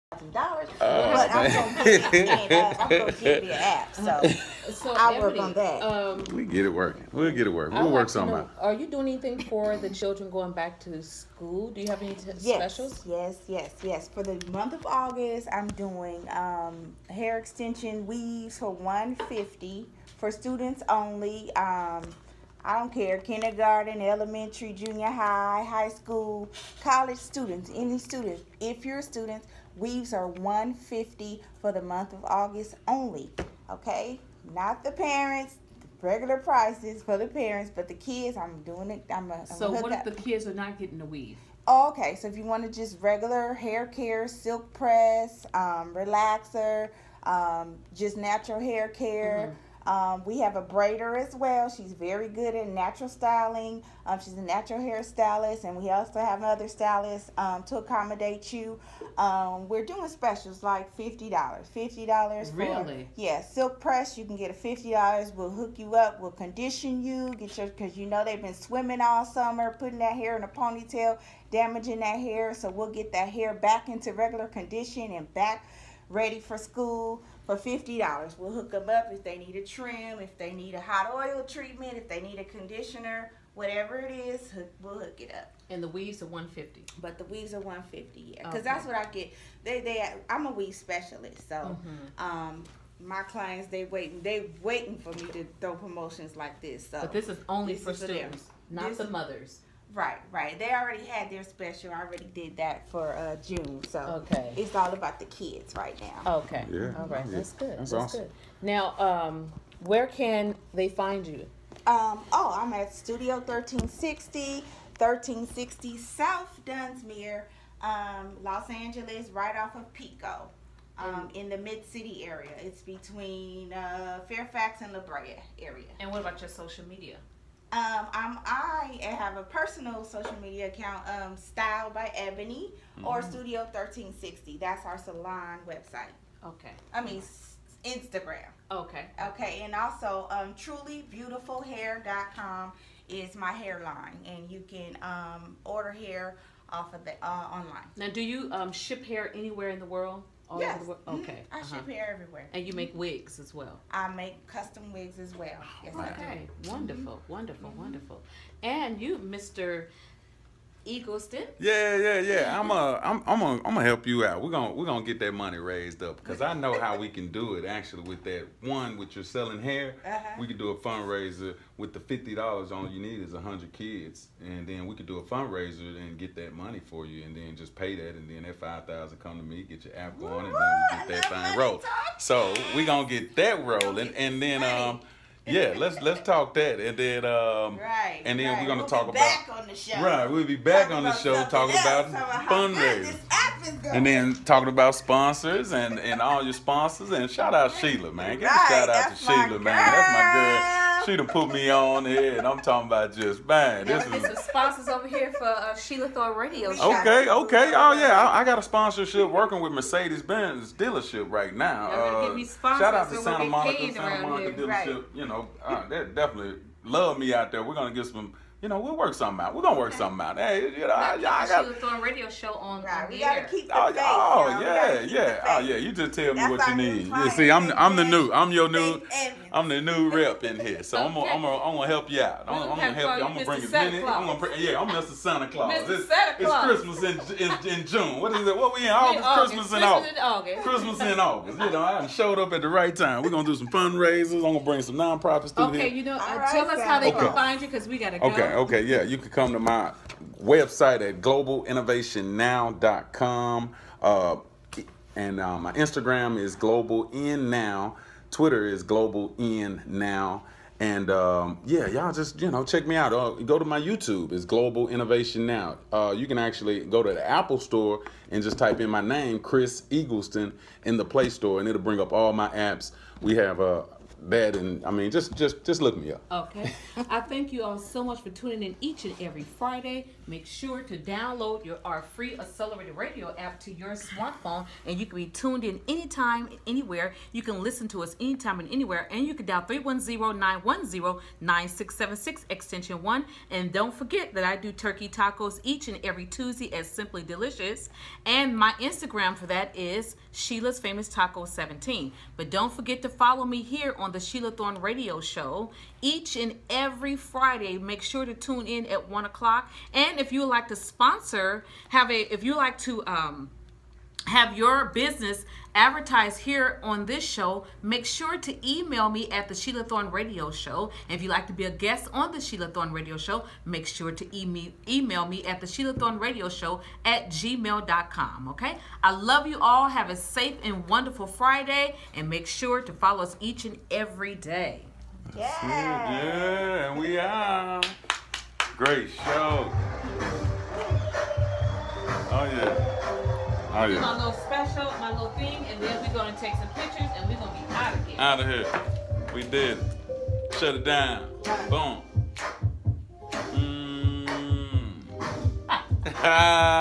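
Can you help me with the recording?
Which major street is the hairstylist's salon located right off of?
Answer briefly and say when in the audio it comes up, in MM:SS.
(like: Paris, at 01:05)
Pico, at 01:59.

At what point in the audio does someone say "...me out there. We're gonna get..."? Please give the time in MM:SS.
03:37.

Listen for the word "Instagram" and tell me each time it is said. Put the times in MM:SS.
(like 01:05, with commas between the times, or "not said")
02:17, 04:15, 04:58.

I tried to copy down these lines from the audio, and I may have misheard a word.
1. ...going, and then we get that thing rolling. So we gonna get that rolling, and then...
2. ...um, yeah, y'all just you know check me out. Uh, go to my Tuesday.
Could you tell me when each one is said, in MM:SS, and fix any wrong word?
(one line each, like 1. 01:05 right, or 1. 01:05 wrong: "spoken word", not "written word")
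1. 03:00 right
2. 04:21 wrong: "YouTube", not "Tuesday".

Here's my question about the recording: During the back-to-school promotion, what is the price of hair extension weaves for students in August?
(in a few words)
$150.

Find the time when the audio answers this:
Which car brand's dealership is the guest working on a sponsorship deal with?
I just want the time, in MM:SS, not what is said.
03:29.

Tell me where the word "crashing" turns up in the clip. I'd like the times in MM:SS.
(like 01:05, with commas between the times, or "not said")
not said.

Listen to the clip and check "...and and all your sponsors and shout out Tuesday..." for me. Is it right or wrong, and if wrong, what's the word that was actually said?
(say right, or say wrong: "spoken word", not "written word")
wrong: "Sheila", not "Tuesday".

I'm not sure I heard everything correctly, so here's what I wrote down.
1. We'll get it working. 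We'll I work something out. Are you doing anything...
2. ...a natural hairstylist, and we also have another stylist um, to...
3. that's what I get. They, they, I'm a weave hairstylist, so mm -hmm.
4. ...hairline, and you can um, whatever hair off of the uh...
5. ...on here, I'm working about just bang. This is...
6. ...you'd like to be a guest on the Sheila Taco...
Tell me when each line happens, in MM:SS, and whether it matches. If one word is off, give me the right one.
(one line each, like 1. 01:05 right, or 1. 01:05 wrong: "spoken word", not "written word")
1. 00:07 right
2. 00:54 right
3. 01:28 wrong: "specialist", not "hairstylist"
4. 02:23 wrong: "order", not "whatever"
5. 03:21 wrong: "talking", not "working"
6. 05:21 wrong: "Thorne", not "Taco".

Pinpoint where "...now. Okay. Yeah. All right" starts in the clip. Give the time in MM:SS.
01:45.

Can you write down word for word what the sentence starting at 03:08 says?
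we're gonna we'll talk about on the show.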